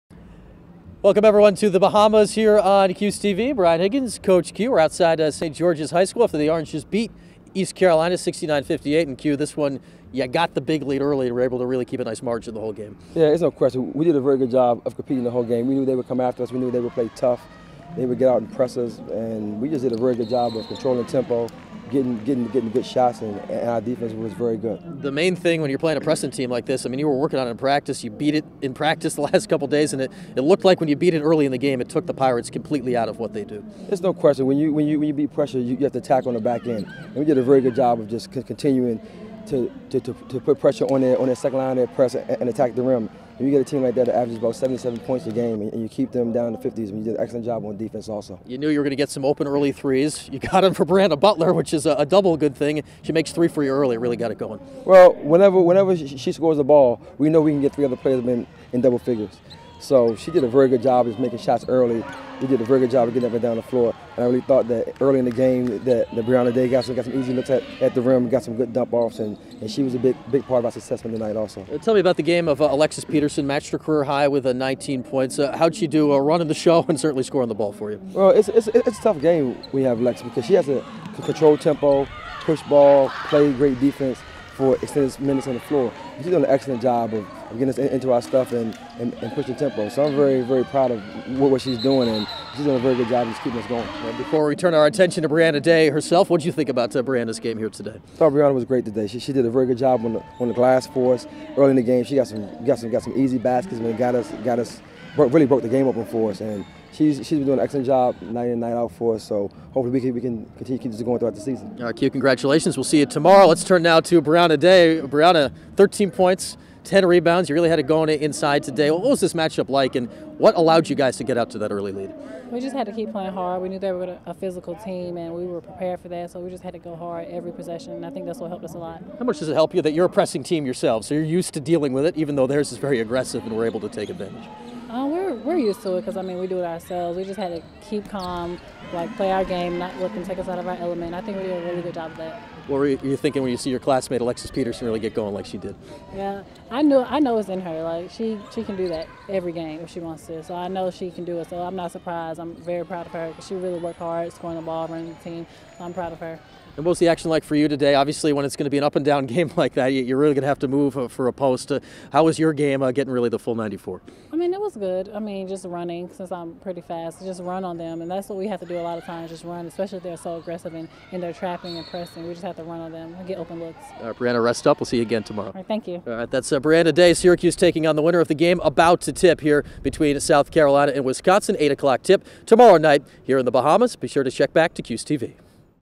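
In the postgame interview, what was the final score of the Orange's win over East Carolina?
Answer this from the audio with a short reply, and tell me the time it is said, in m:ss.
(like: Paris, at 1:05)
69-58, at 0:08.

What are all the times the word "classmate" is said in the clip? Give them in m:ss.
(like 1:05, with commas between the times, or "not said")
2:23.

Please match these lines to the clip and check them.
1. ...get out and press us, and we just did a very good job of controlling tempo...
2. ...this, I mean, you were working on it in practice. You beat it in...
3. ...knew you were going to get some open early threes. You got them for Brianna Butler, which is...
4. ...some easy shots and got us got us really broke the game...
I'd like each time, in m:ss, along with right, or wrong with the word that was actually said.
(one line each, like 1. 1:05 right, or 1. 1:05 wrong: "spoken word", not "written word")
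1. 0:18 right
2. 0:26 right
3. 0:48 right
4. 1:43 wrong: "baskets", not "shots".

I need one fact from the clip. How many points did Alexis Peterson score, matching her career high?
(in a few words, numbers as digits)
19.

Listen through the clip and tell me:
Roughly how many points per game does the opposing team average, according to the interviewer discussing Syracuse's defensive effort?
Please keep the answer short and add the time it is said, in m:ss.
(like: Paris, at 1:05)
77, at 0:44.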